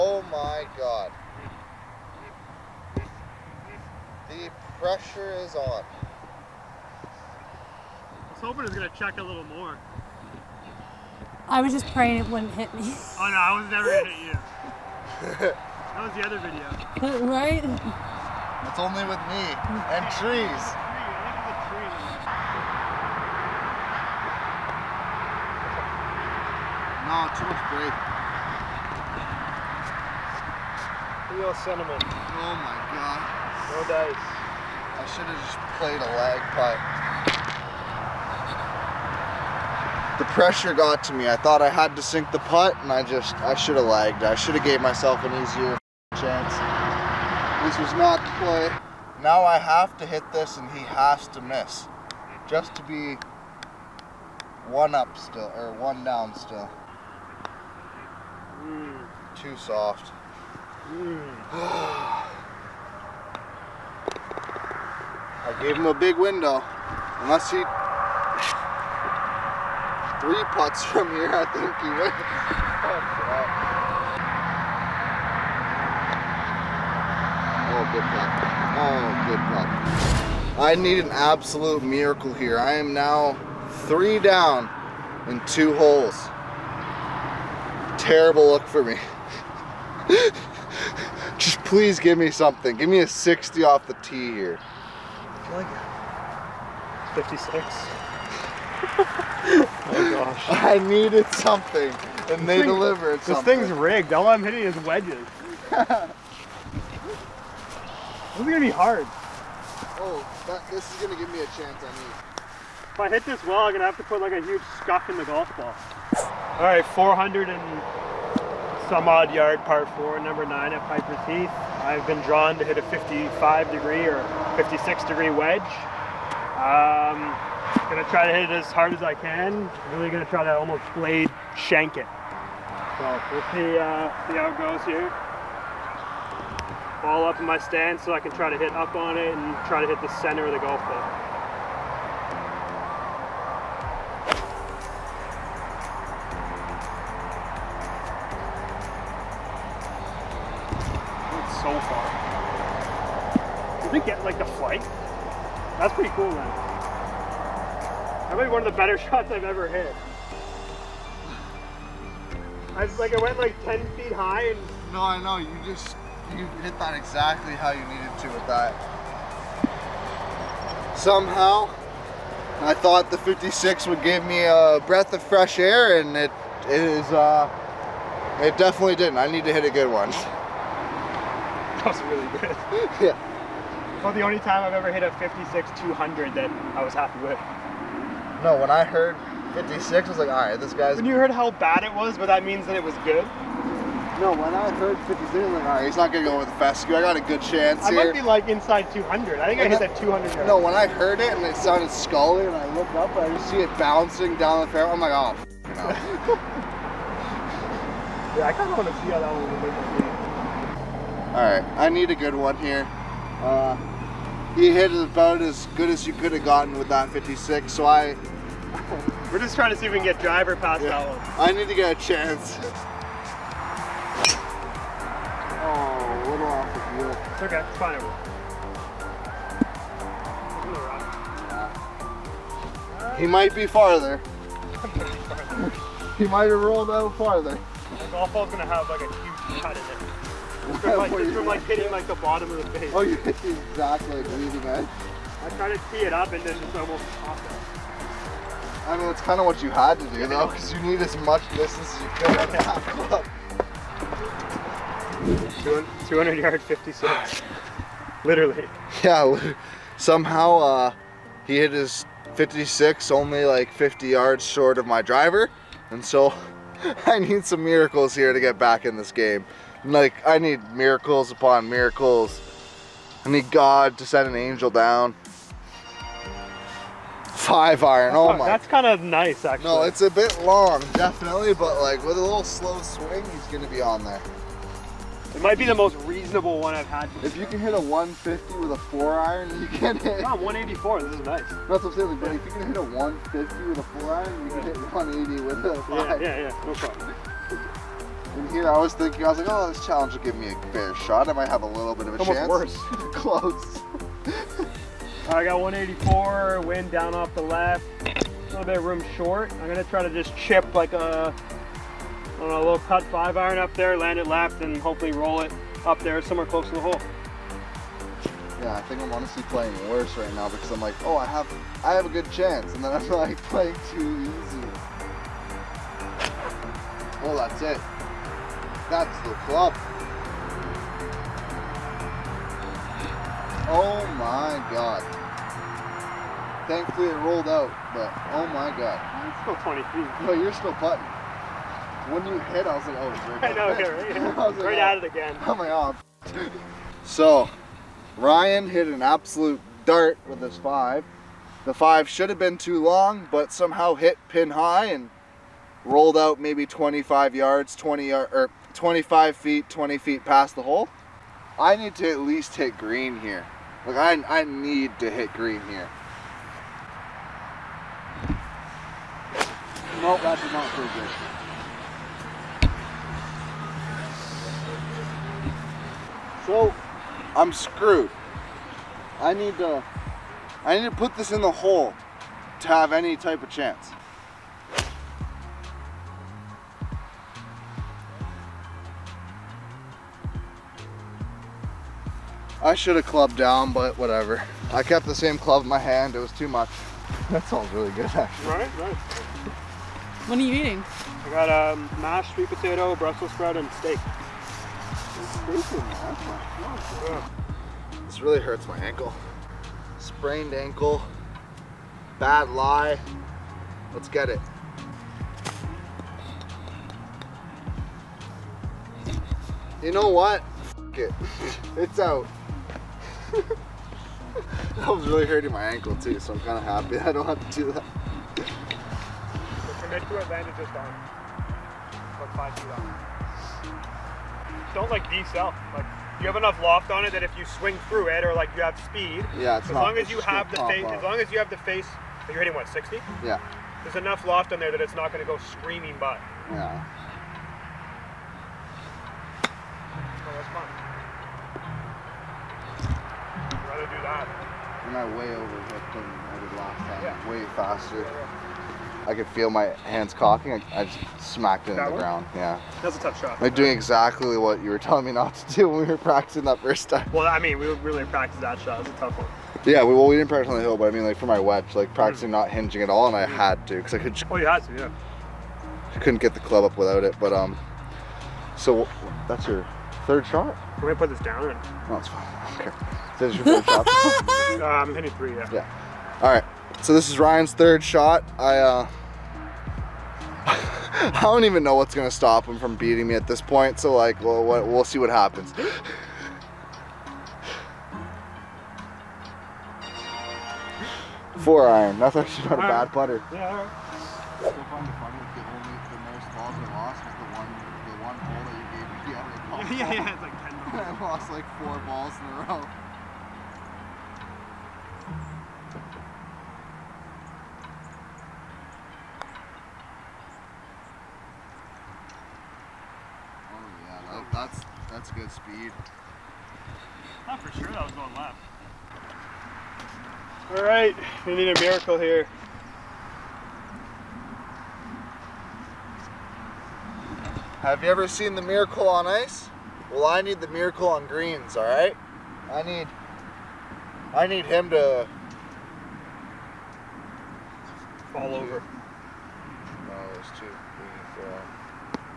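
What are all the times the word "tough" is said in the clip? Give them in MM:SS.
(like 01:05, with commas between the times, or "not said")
07:43, 07:48.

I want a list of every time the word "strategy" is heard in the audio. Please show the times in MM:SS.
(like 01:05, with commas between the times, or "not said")
not said.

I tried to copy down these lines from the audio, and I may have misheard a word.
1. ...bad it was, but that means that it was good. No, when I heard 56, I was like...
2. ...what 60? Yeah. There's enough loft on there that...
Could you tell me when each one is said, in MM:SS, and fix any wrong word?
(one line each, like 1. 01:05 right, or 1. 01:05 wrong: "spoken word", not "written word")
1. 03:11 right
2. 07:22 right.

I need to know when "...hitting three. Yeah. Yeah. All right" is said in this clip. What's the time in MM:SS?
08:04.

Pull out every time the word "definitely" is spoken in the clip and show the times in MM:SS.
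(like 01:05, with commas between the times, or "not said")
02:58, 04:40.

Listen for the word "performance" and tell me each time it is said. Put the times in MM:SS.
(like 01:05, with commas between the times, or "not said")
not said.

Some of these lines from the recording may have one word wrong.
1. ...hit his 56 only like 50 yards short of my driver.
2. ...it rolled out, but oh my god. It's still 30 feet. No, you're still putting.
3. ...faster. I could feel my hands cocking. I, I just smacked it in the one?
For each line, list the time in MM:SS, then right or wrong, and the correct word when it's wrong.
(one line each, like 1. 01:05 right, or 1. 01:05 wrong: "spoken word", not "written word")
1. 04:21 right
2. 05:37 wrong: "20", not "30"
3. 07:37 right.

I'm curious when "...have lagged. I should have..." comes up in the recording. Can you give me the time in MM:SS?
00:43.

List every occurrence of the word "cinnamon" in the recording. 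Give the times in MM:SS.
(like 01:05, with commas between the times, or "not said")
00:31.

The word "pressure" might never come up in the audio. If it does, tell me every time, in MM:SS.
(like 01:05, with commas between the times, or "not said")
00:04, 00:40.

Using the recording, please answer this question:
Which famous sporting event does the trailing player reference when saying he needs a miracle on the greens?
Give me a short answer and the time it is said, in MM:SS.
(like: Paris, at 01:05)
Miracle on Ice, at 08:58.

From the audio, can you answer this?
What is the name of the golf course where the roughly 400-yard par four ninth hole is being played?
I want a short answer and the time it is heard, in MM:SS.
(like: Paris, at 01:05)
Piper's Heath, at 02:00.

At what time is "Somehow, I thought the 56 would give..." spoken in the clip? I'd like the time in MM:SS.
02:50.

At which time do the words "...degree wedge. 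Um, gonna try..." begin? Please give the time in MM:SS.
02:05.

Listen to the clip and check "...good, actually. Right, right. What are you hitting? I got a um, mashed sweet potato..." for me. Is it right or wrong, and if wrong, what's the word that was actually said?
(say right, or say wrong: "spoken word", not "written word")
wrong: "eating", not "hitting".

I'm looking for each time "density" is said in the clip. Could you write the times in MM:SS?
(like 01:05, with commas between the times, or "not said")
not said.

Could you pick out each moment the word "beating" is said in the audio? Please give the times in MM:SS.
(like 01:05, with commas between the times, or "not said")
08:12.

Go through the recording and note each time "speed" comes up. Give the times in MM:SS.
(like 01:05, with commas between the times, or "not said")
07:18, 08:45.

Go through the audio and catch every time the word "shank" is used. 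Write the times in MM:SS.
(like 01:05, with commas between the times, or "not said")
02:11.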